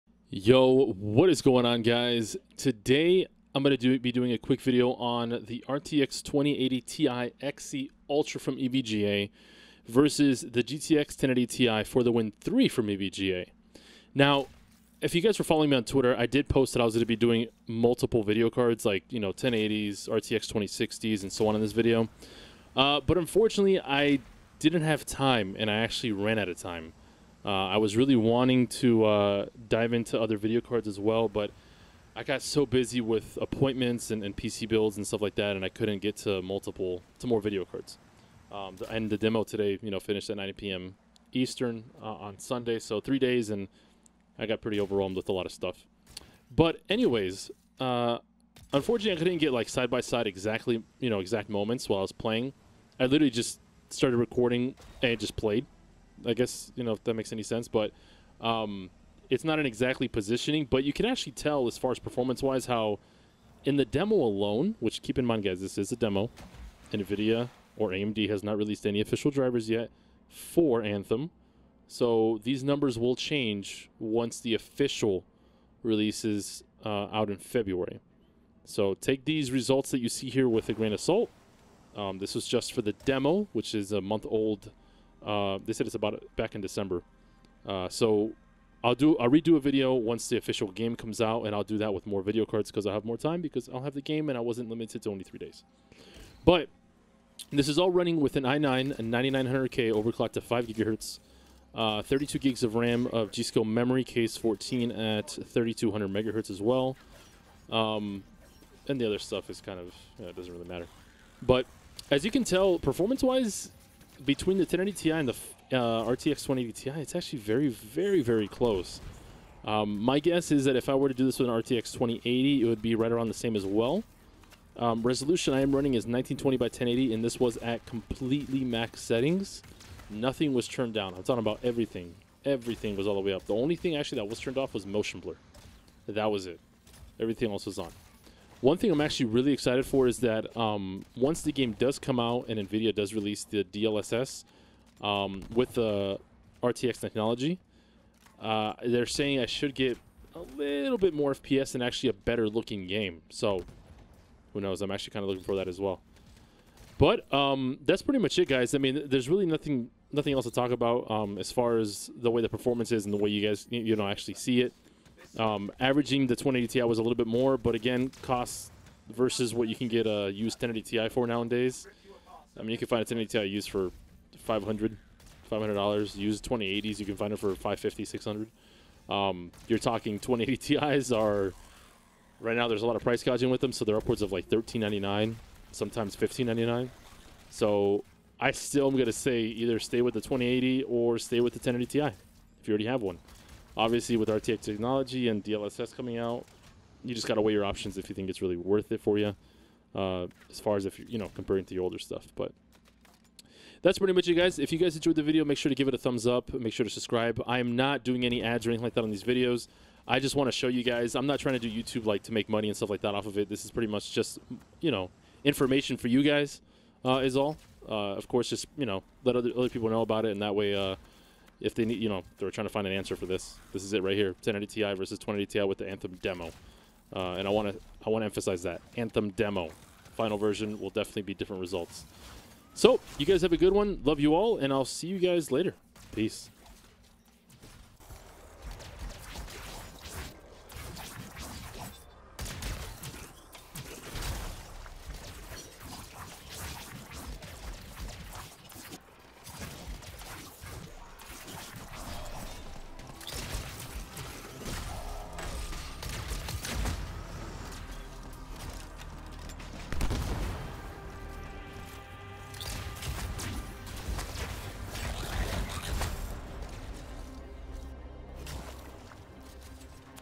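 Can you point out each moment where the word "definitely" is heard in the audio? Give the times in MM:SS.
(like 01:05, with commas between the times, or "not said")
03:50.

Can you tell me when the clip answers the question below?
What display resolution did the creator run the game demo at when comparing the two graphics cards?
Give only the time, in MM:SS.
02:06.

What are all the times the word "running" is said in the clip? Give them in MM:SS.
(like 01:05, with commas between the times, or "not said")
01:37, 02:05.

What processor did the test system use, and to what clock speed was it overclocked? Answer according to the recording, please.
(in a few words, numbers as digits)
i9 9900K at 5 GHz.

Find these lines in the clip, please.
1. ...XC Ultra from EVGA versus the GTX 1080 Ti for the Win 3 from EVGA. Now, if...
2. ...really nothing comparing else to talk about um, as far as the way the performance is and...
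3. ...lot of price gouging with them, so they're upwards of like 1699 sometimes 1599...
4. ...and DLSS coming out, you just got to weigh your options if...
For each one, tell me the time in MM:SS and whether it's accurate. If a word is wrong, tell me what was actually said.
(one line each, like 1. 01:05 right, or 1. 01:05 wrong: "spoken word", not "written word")
1. 00:07 right
2. 02:39 wrong: "nothing", not "comparing"
3. 03:02 wrong: "1399", not "1699"
4. 03:15 right.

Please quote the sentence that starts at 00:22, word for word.
Uh, but unfortunately, I didn't have time and I actually ran out of time.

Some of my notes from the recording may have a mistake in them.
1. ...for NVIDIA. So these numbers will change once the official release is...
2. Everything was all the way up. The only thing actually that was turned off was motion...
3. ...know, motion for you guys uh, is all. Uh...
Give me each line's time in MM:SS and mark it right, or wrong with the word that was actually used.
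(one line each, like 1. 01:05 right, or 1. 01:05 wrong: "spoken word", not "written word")
1. 01:10 wrong: "Anthem", not "NVIDIA"
2. 02:12 right
3. 03:34 wrong: "information", not "motion".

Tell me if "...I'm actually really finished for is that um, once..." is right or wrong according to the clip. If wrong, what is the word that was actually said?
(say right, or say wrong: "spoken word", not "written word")
wrong: "excited", not "finished".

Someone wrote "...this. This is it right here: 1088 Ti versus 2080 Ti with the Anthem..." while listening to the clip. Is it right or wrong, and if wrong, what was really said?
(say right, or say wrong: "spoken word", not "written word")
wrong: "1080", not "1088".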